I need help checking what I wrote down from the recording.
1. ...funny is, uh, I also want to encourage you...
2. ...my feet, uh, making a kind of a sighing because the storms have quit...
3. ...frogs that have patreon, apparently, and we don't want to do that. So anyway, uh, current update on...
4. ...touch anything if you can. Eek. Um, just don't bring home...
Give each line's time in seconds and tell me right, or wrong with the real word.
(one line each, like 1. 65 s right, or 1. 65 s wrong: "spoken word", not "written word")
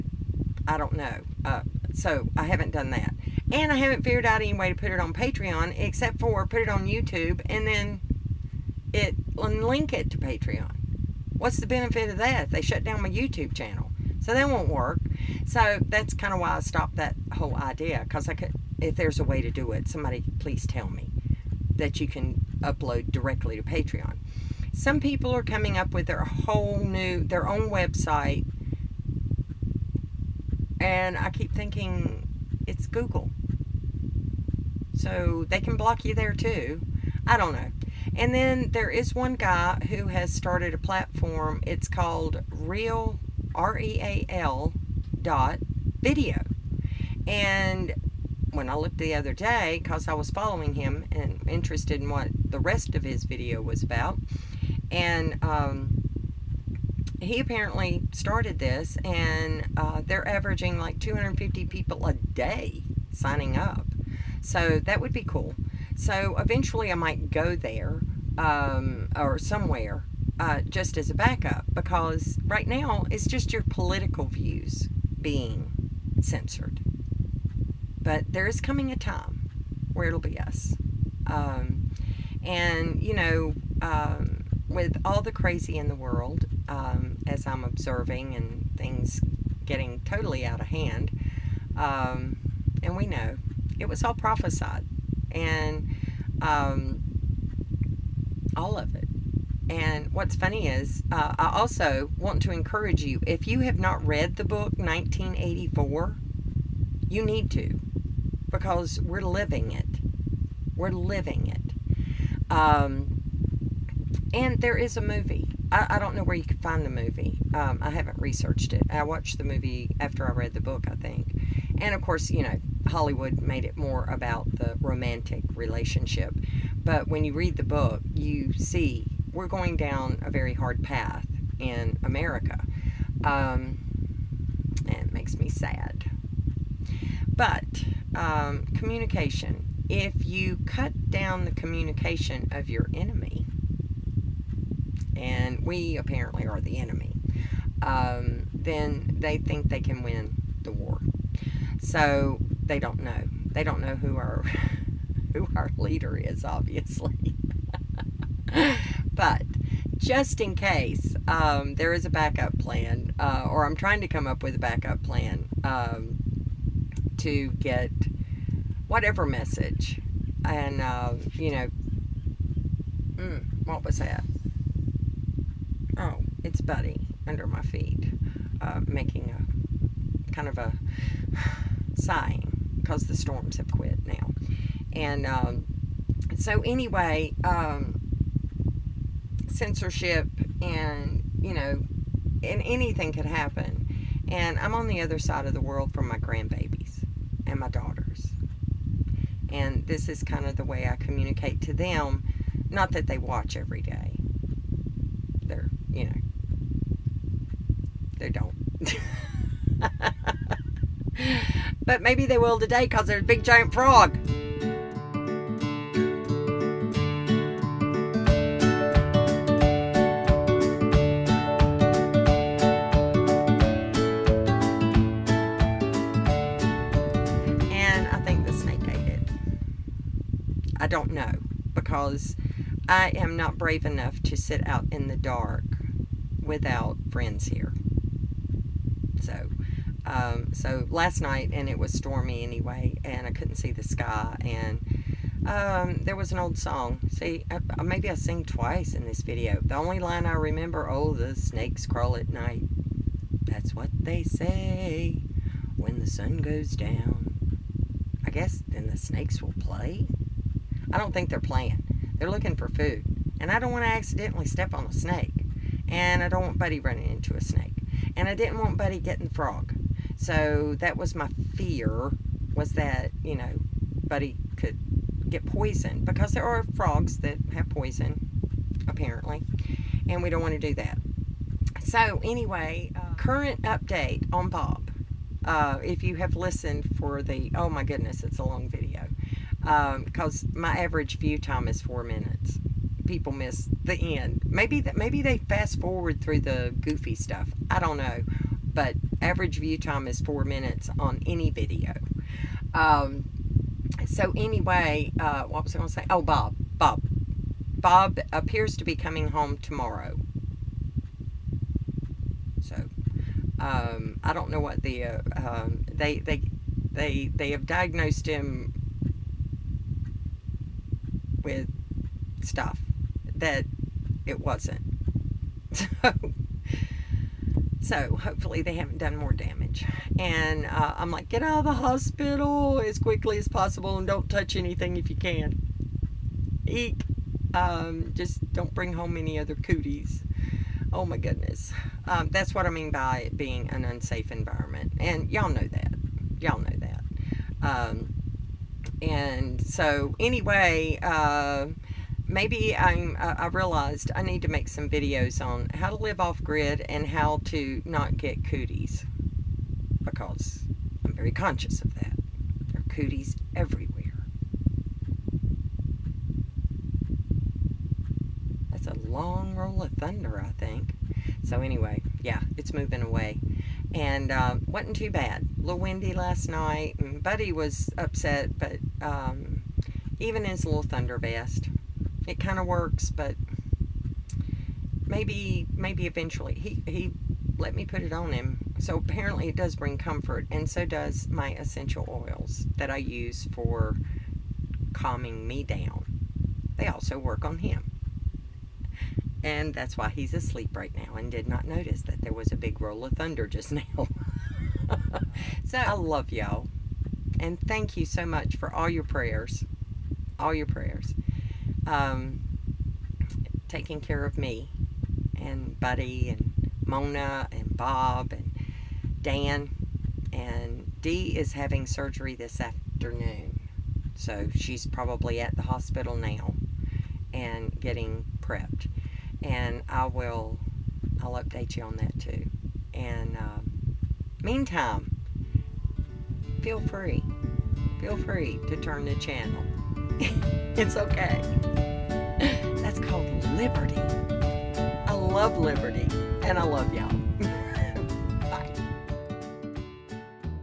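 1. 100 s right
2. 177 s right
3. 276 s wrong: "poison", not "patreon"
4. 334 s right.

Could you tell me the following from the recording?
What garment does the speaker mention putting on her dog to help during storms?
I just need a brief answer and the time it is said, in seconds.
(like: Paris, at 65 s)
thunder vest, at 380 s.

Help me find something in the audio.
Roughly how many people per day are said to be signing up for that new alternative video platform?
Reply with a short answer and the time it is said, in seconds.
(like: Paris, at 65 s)
250, at 60 s.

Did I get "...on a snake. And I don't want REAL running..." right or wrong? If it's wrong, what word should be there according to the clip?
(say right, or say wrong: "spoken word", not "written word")
wrong: "Buddy", not "REAL".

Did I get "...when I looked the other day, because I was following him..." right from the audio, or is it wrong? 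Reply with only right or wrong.
right.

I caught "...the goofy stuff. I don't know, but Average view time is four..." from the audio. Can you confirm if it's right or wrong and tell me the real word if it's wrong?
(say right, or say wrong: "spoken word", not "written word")
right.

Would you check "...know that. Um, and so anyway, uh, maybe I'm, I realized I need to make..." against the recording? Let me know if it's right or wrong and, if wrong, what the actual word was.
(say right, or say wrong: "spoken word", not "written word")
right.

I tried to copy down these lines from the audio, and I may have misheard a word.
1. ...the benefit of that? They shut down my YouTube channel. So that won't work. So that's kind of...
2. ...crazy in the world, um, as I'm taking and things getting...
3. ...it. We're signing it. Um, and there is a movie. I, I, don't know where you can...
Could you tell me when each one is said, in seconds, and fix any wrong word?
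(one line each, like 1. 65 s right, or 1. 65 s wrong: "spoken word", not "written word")
1. 11 s right
2. 85 s wrong: "observing", not "taking"
3. 109 s wrong: "living", not "signing".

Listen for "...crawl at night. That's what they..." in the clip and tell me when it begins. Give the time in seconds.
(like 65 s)
251 s.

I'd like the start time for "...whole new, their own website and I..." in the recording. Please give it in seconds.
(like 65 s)
26 s.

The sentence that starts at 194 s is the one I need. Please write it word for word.
And I'm on the other side of the world from my grandbabies and my daughters.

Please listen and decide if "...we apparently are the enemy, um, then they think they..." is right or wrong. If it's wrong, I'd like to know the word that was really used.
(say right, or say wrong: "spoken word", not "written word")
right.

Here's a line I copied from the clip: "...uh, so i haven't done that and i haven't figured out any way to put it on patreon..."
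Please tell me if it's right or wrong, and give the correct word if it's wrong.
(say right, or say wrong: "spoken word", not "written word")
right.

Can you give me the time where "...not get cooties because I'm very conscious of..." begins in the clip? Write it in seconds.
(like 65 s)
357 s.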